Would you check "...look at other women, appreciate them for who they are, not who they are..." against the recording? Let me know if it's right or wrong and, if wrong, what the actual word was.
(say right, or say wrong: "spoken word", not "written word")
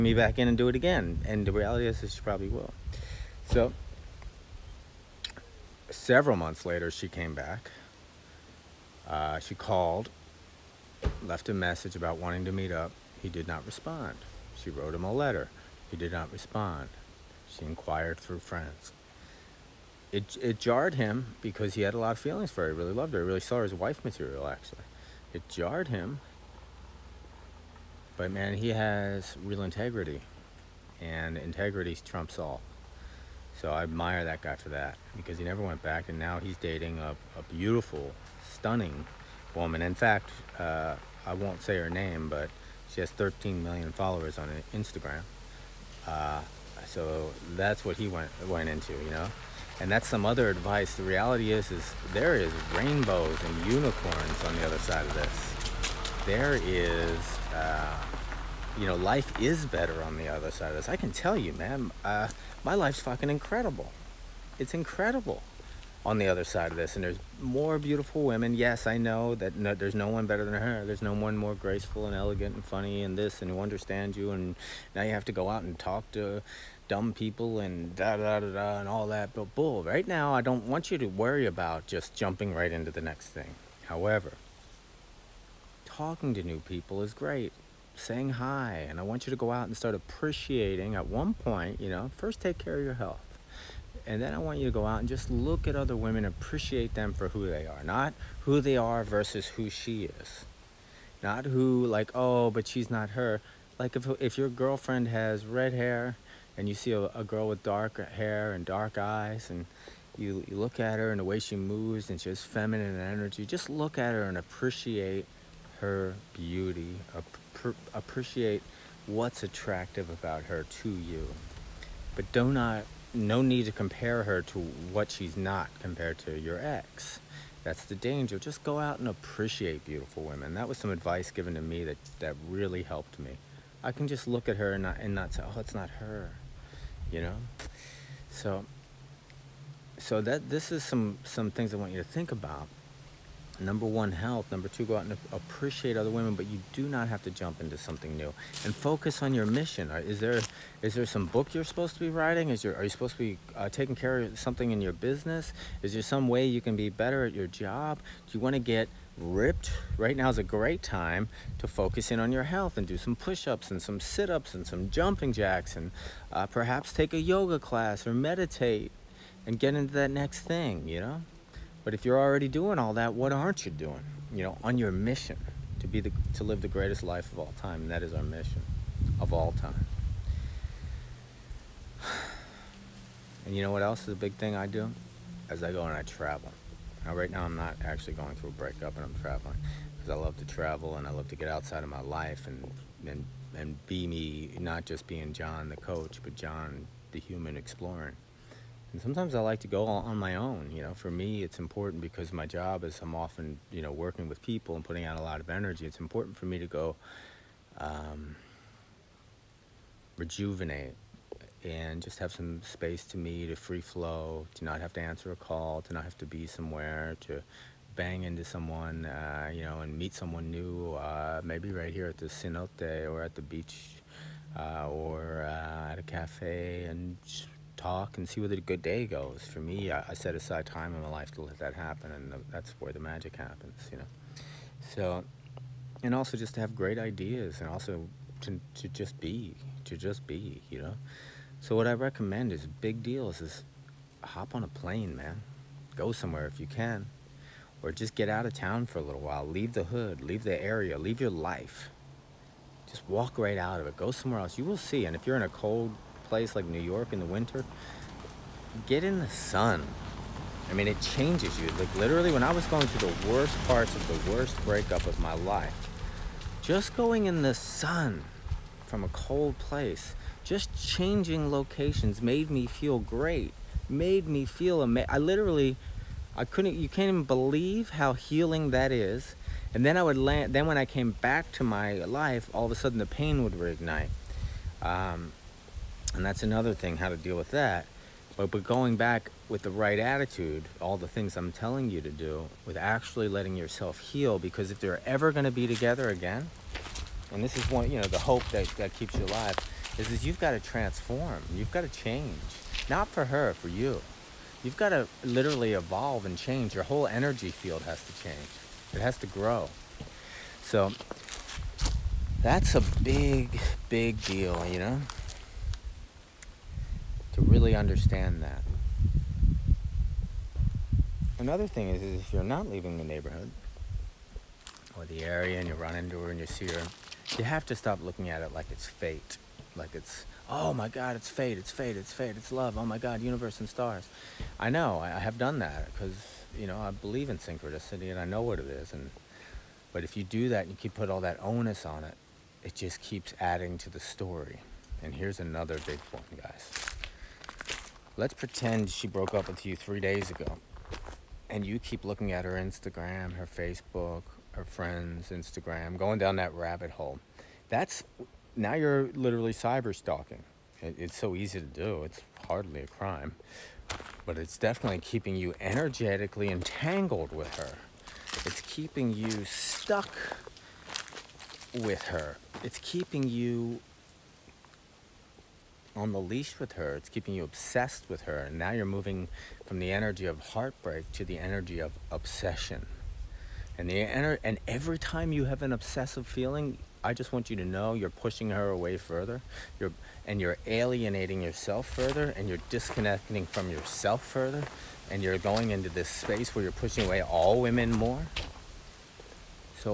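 right.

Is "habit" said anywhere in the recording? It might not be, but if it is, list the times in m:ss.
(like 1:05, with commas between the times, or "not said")
not said.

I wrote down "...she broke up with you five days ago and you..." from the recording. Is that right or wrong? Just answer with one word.
wrong.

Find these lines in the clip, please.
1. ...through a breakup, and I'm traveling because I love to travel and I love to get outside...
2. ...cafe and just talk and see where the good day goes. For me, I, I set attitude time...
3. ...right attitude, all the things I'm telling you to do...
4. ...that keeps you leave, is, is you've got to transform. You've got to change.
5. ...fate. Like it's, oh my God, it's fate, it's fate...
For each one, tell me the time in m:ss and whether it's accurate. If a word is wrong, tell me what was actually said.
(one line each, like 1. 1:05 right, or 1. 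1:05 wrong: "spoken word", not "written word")
1. 3:08 right
2. 3:46 wrong: "aside", not "attitude"
3. 4:49 right
4. 4:58 wrong: "alive", not "leave"
5. 5:28 right.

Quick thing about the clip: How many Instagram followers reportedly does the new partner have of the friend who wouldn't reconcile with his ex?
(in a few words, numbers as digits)
13 million.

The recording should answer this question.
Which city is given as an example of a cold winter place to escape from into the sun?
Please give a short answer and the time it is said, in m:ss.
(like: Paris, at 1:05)
New York, at 4:16.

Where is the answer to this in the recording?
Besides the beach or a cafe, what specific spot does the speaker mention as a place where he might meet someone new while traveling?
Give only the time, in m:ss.
3:42.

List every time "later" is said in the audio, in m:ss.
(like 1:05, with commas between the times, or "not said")
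0:06.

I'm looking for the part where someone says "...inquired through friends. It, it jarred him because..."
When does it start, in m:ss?
0:17.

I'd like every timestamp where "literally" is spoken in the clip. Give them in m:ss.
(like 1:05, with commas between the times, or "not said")
4:21, 4:35, 5:05, 5:59.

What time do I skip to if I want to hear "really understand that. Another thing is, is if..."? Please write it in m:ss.
5:17.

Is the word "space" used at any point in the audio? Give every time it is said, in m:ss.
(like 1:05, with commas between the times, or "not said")
3:32, 6:36.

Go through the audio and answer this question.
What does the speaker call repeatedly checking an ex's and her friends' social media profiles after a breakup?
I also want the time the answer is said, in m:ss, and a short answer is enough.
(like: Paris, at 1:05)
cyber stalking, at 5:59.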